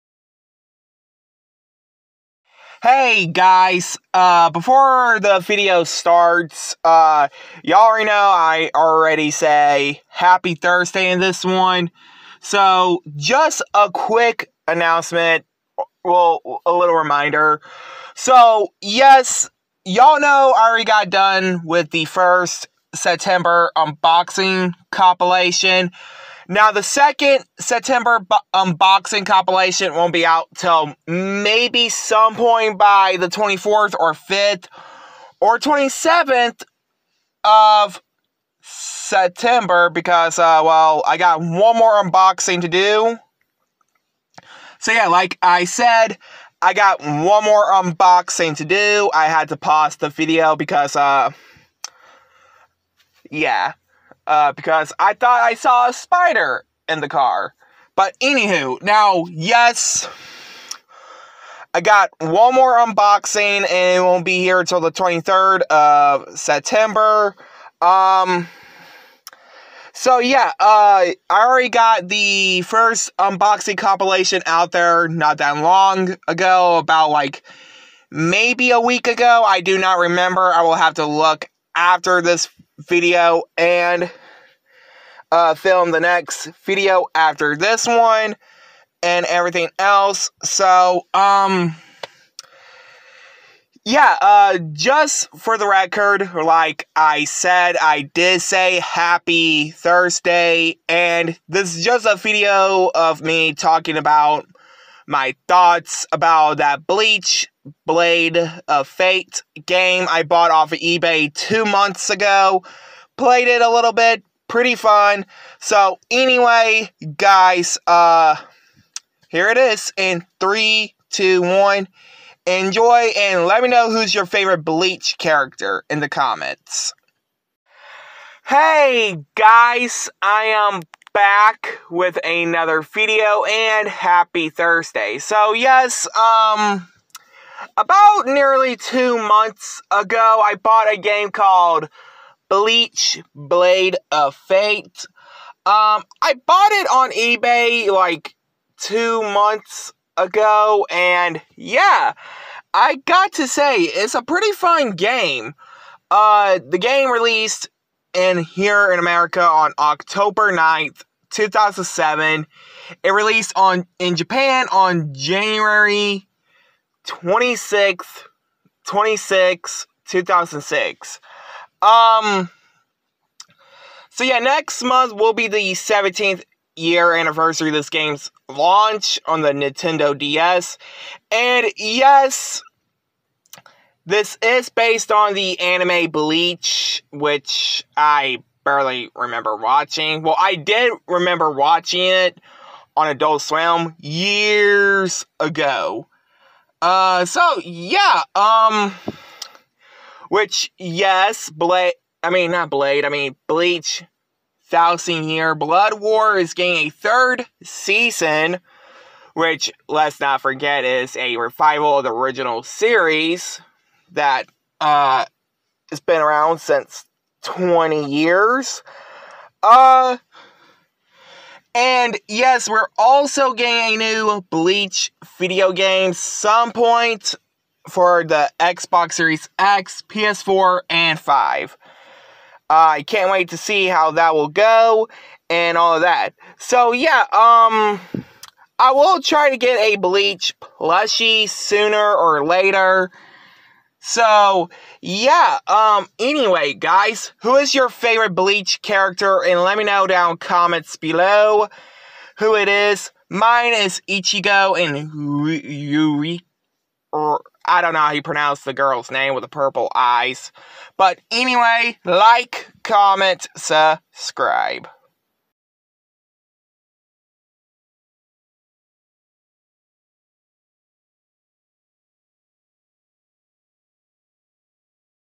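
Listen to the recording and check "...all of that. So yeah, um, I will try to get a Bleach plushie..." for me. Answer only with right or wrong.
right.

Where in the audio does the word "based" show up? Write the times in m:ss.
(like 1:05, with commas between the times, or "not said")
3:04.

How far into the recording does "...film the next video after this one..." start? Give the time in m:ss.
1:25.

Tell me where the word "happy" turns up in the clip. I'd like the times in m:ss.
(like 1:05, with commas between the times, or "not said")
0:10, 1:38, 2:13.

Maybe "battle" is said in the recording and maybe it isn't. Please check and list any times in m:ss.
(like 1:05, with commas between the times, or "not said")
not said.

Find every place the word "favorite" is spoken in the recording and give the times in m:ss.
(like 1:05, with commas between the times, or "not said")
2:04, 4:07.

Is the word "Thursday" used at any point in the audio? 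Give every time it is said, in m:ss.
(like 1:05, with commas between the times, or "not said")
0:10, 1:39, 2:14.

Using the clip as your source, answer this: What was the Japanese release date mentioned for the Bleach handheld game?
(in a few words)
January 26, 2006.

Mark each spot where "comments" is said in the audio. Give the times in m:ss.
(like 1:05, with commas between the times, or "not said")
2:06, 4:10, 4:22.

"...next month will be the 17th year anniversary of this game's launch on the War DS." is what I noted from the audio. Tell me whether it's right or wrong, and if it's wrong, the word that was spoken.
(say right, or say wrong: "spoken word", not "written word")
wrong: "Nintendo", not "War".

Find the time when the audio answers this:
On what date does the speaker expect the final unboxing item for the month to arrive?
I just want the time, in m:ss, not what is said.
1:04.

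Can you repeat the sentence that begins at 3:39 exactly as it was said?
Uh, and yes, we're also getting a new Bleach video game some point for the Xbox Series X, PS4, and 5.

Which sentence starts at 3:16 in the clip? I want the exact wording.
Uh, so yeah, um, which yes, Blade.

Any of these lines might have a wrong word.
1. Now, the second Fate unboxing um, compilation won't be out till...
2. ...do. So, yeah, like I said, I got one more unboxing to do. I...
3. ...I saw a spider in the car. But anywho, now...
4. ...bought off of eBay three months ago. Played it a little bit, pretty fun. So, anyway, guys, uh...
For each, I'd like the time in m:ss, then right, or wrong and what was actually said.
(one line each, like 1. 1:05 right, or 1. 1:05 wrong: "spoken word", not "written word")
1. 0:26 wrong: "September", not "Fate"
2. 0:42 right
3. 0:55 right
4. 1:50 wrong: "two", not "three".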